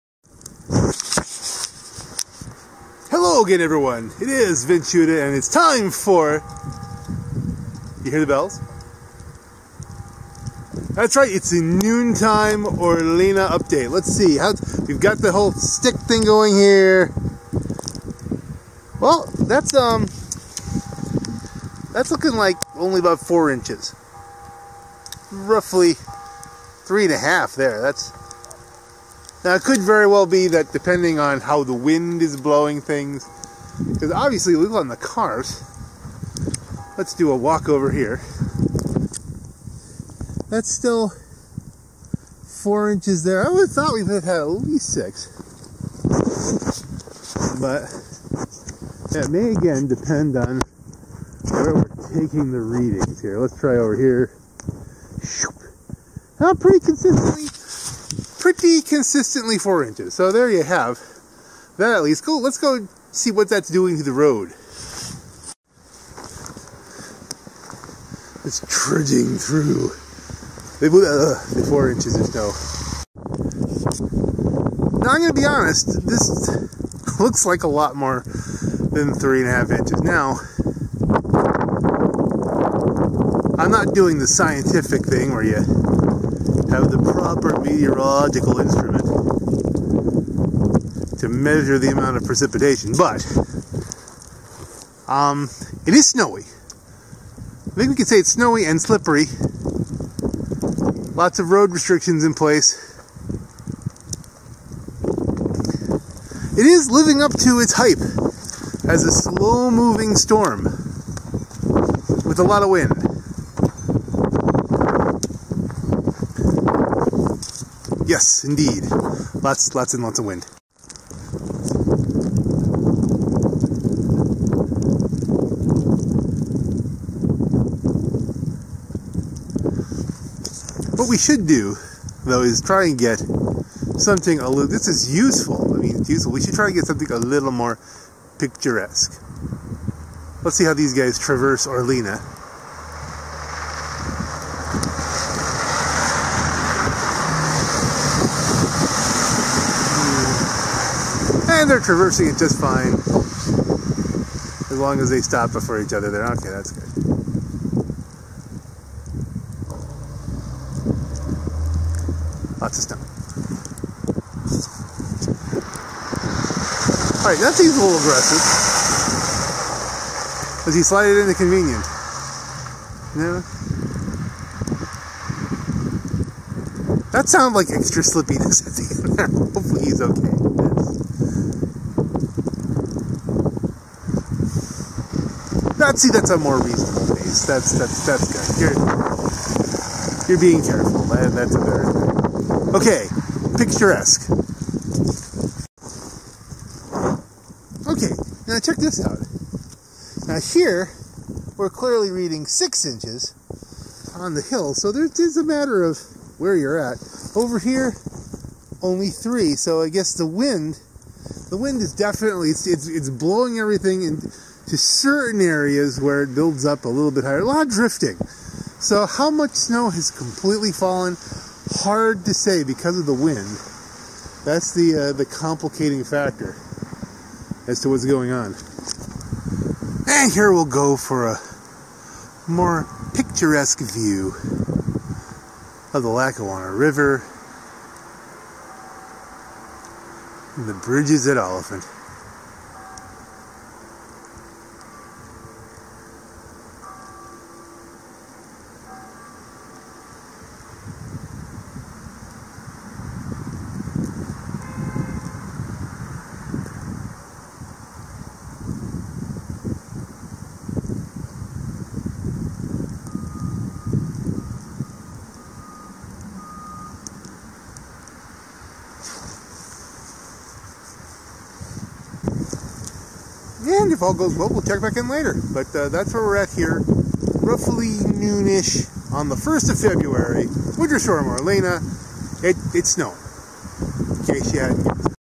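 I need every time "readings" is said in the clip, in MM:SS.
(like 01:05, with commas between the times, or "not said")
00:52, 03:22.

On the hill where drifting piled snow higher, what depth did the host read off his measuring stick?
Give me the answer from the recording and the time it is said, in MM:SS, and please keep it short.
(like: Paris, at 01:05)
6 inches, at 03:22.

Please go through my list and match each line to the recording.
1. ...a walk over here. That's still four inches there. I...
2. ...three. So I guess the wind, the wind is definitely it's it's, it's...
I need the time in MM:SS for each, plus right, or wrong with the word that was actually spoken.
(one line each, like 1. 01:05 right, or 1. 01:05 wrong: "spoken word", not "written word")
1. 00:37 right
2. 03:29 right.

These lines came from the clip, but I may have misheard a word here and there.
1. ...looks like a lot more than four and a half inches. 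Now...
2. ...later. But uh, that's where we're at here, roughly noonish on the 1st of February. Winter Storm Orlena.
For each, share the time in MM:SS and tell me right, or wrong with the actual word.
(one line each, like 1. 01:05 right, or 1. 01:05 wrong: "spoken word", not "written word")
1. 01:17 wrong: "three", not "four"
2. 04:35 right.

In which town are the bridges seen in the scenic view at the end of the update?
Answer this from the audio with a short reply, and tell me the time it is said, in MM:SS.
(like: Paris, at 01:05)
Olyphant, at 04:01.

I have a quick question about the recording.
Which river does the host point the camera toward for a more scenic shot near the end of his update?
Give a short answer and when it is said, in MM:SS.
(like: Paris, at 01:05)
Lackawanna River, at 03:56.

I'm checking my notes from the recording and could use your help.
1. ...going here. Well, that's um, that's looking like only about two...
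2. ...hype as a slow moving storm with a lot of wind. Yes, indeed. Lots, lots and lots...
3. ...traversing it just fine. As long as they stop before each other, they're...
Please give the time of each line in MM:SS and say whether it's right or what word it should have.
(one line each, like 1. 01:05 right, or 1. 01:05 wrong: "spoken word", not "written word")
1. 00:16 wrong: "four", not "two"
2. 01:47 right
3. 02:31 right.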